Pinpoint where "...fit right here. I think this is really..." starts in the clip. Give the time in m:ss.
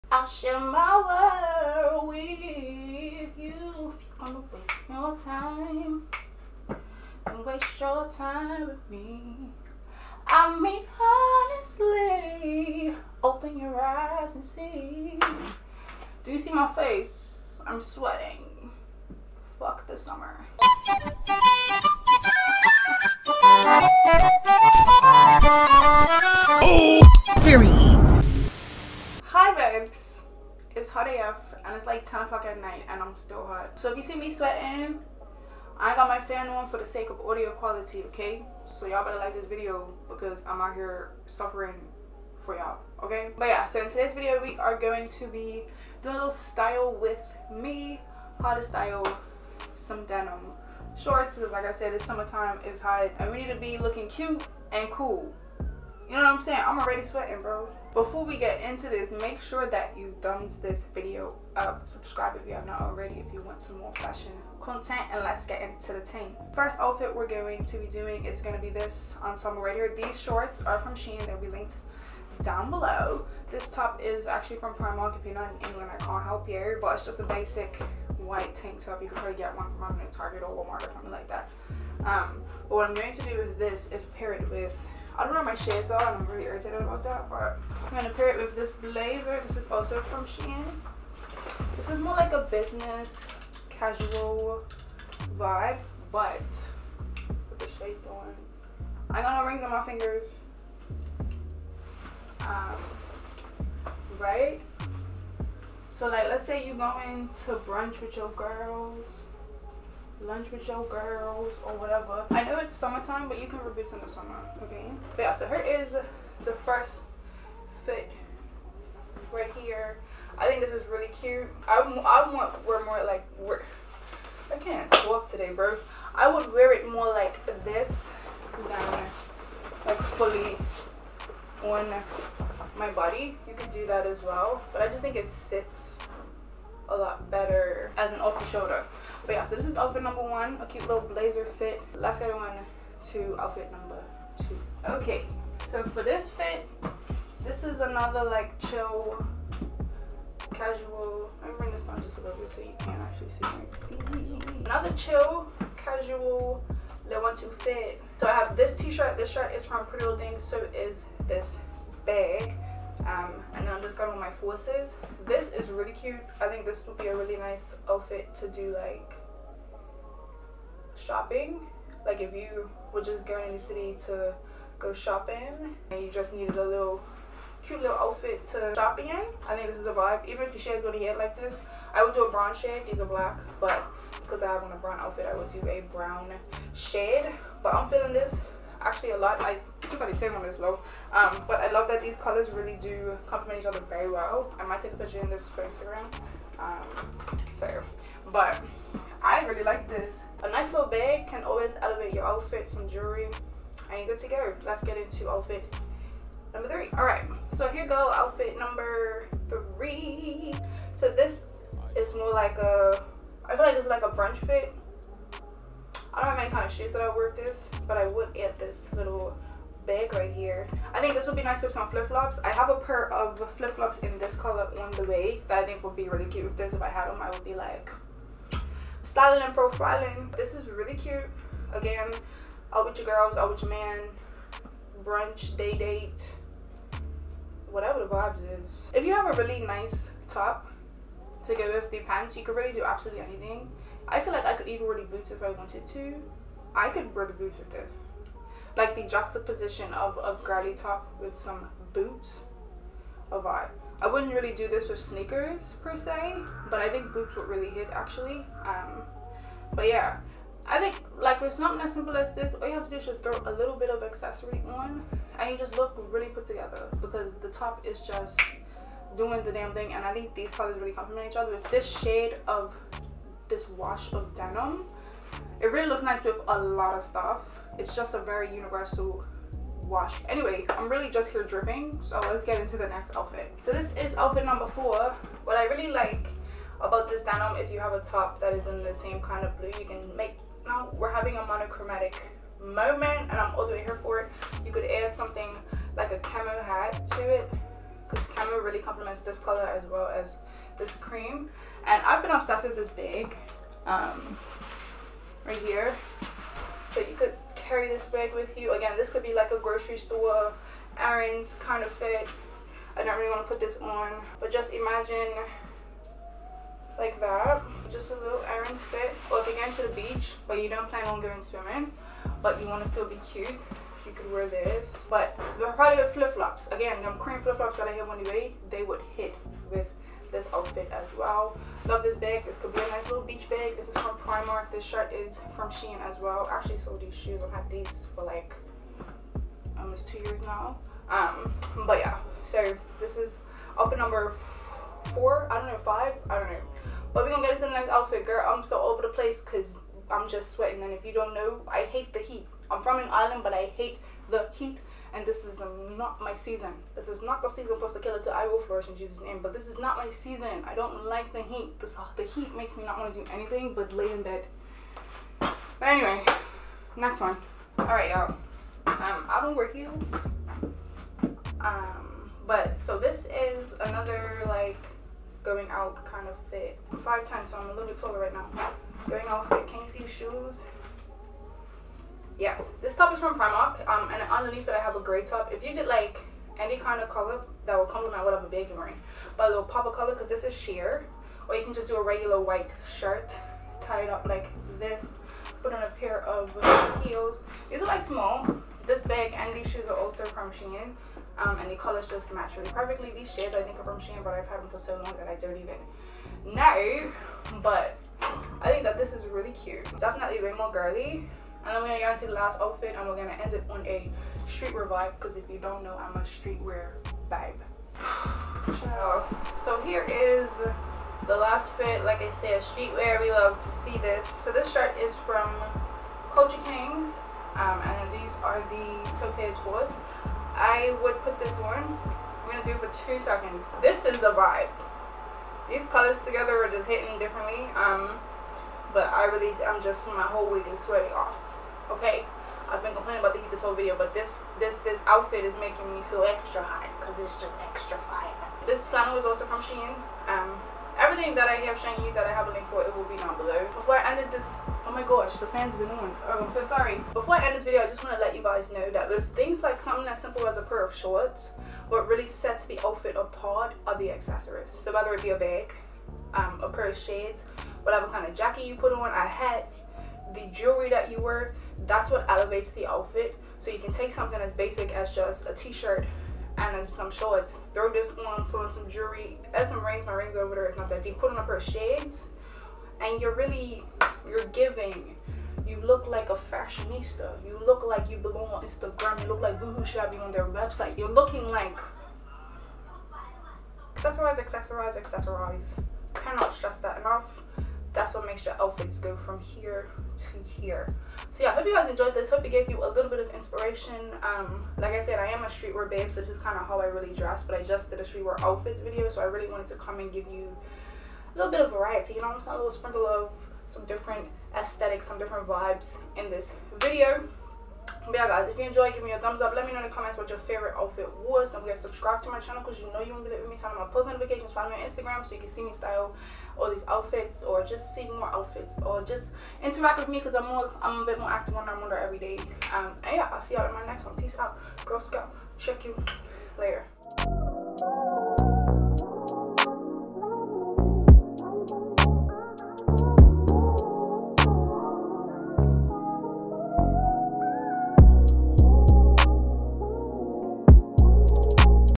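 1:57.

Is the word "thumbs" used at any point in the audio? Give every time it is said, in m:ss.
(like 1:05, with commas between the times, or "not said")
1:00, 8:39.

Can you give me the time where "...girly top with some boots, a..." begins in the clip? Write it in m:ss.
4:10.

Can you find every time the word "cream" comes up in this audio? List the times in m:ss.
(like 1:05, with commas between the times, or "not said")
5:00, 5:27.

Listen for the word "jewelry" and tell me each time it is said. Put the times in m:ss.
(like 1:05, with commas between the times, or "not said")
3:22, 7:50, 7:58.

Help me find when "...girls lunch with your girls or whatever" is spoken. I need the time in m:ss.
1:48.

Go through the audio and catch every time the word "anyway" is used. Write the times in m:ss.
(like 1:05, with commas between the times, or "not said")
4:40, 6:05.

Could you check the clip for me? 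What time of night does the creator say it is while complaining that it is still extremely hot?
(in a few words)
10 o'clock.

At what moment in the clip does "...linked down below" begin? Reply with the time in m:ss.
1:11.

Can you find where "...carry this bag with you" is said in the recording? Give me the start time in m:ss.
5:07.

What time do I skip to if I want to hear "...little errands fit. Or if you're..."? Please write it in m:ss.
5:18.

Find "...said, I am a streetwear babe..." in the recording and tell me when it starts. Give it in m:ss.
8:25.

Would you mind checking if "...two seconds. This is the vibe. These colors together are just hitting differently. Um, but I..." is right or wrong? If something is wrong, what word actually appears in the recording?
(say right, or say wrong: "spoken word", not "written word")
right.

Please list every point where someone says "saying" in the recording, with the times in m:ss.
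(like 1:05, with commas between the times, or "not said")
0:56, 8:32.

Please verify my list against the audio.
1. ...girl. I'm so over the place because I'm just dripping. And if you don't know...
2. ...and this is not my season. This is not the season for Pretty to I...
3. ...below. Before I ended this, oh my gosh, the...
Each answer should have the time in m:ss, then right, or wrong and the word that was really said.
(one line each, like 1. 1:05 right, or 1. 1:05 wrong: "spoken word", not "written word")
1. 5:48 wrong: "sweating", not "dripping"
2. 5:55 wrong: "Sakaela", not "Pretty"
3. 7:33 right.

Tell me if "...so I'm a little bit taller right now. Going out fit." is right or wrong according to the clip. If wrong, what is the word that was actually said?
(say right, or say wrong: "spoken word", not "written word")
right.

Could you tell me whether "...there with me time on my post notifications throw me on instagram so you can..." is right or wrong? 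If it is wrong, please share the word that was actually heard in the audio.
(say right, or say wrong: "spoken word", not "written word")
wrong: "follow", not "throw".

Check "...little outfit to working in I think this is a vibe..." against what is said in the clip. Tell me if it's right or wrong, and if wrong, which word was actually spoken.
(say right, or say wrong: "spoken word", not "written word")
wrong: "shopping", not "working".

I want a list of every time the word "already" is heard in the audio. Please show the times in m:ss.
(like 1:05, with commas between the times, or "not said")
0:56, 1:02.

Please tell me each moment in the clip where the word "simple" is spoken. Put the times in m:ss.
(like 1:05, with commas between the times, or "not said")
4:21, 7:40.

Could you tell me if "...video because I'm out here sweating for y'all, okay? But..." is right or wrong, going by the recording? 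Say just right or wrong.
wrong.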